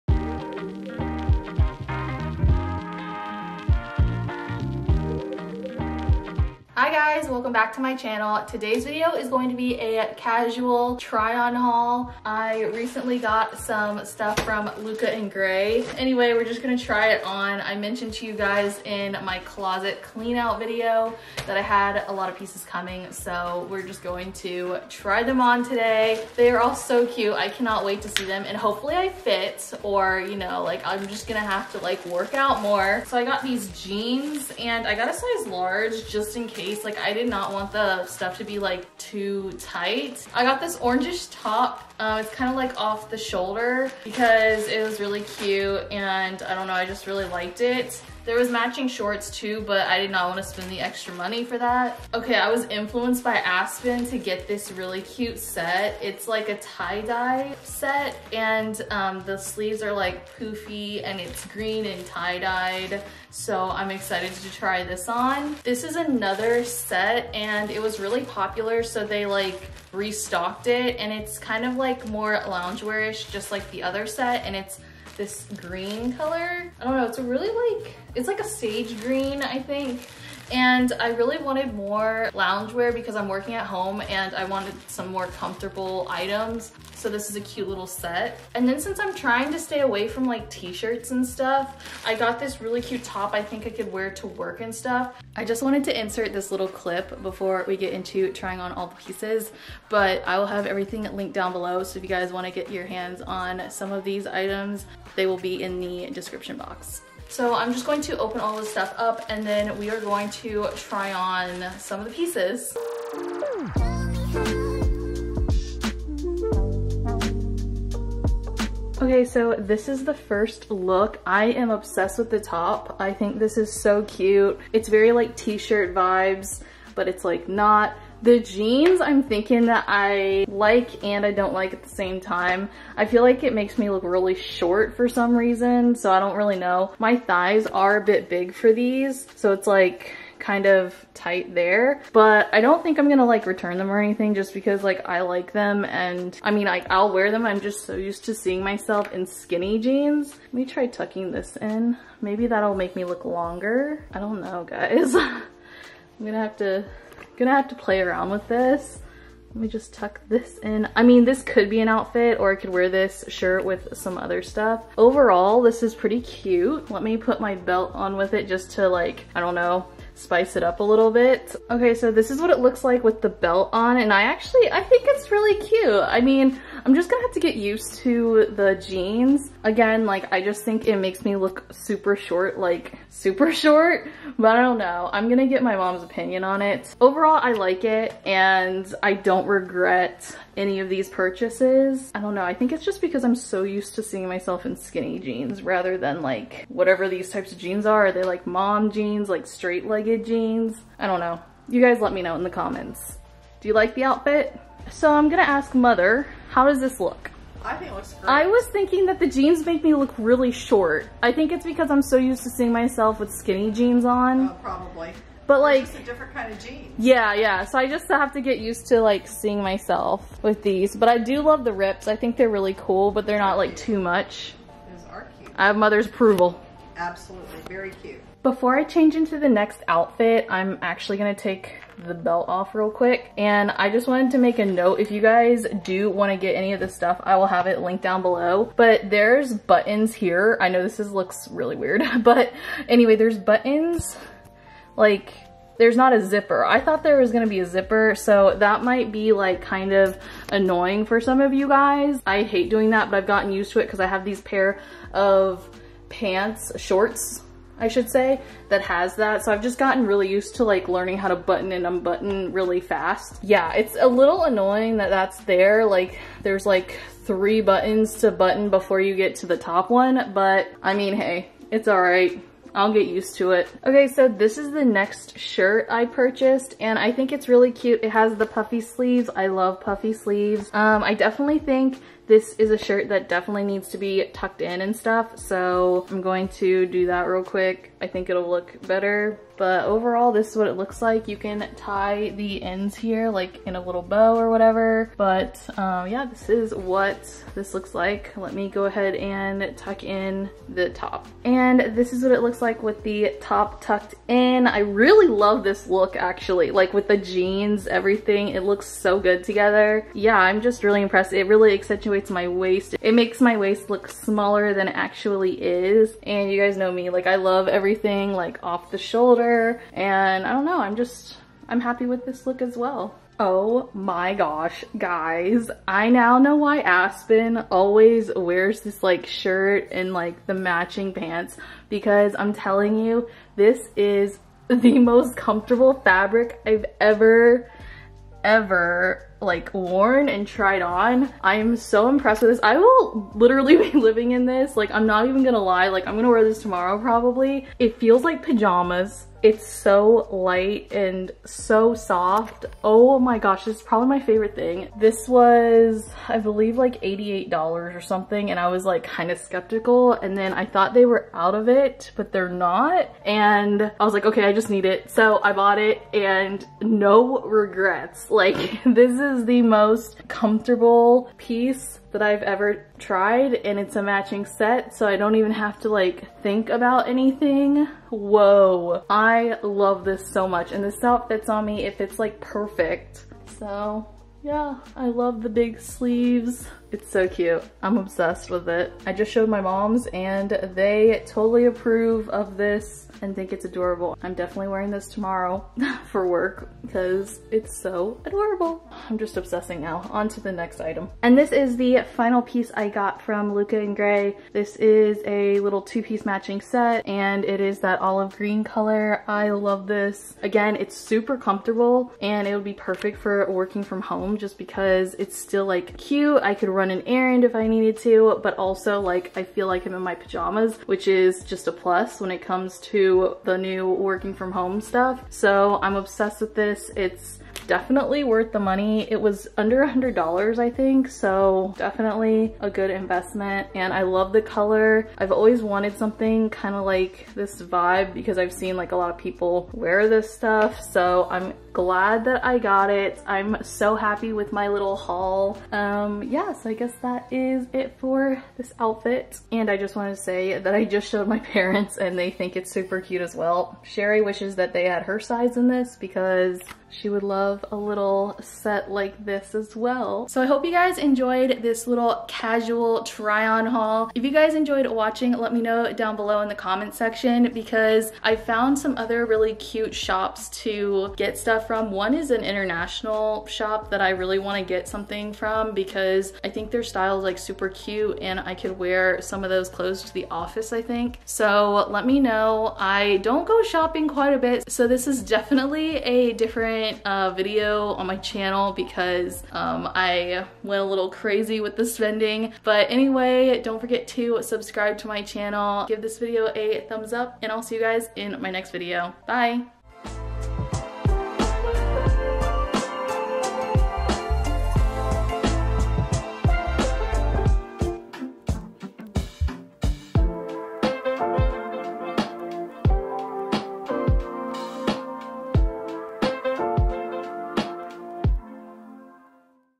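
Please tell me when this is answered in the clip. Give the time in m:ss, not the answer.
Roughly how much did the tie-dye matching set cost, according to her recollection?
5:57.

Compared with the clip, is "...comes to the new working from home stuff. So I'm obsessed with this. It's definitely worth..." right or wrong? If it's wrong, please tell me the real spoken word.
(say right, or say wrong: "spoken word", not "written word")
right.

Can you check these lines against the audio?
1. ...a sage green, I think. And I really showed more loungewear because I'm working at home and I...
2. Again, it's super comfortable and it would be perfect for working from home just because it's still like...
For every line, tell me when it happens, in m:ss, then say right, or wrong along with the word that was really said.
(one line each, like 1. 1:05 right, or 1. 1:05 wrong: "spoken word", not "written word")
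1. 1:18 wrong: "wanted", not "showed"
2. 6:50 right.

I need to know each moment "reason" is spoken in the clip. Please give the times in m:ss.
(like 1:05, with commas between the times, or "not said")
2:15.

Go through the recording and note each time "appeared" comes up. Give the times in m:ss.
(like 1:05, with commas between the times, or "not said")
not said.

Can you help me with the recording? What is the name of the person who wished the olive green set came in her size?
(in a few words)
Sherry.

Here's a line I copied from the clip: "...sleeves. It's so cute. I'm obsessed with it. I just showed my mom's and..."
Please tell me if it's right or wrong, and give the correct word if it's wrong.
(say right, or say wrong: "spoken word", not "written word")
right.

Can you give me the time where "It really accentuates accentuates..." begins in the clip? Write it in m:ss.
5:11.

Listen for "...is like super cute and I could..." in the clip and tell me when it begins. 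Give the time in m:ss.
7:57.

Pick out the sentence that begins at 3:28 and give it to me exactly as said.
I was thinking that the jeans make me look really short.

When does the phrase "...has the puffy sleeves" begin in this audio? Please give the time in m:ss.
4:38.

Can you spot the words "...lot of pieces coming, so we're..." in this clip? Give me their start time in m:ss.
0:22.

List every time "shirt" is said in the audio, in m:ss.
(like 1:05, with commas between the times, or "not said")
1:30, 2:05, 2:43, 4:35, 4:42, 5:29.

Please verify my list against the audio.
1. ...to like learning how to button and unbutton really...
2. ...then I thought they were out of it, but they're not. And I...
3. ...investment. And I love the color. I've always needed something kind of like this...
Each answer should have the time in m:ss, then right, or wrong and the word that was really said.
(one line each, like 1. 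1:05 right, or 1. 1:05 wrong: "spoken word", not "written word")
1. 4:20 right
2. 6:00 right
3. 7:12 wrong: "wanted", not "needed".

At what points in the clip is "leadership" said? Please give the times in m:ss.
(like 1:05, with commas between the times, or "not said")
not said.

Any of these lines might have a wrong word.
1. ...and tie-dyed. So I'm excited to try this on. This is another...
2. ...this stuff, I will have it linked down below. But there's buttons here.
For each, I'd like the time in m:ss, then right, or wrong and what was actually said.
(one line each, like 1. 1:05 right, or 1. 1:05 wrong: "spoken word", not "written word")
1. 1:01 right
2. 3:56 right.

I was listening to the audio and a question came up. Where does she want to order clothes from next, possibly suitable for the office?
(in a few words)
international shop.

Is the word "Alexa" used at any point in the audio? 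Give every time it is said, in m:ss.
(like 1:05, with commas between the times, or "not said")
not said.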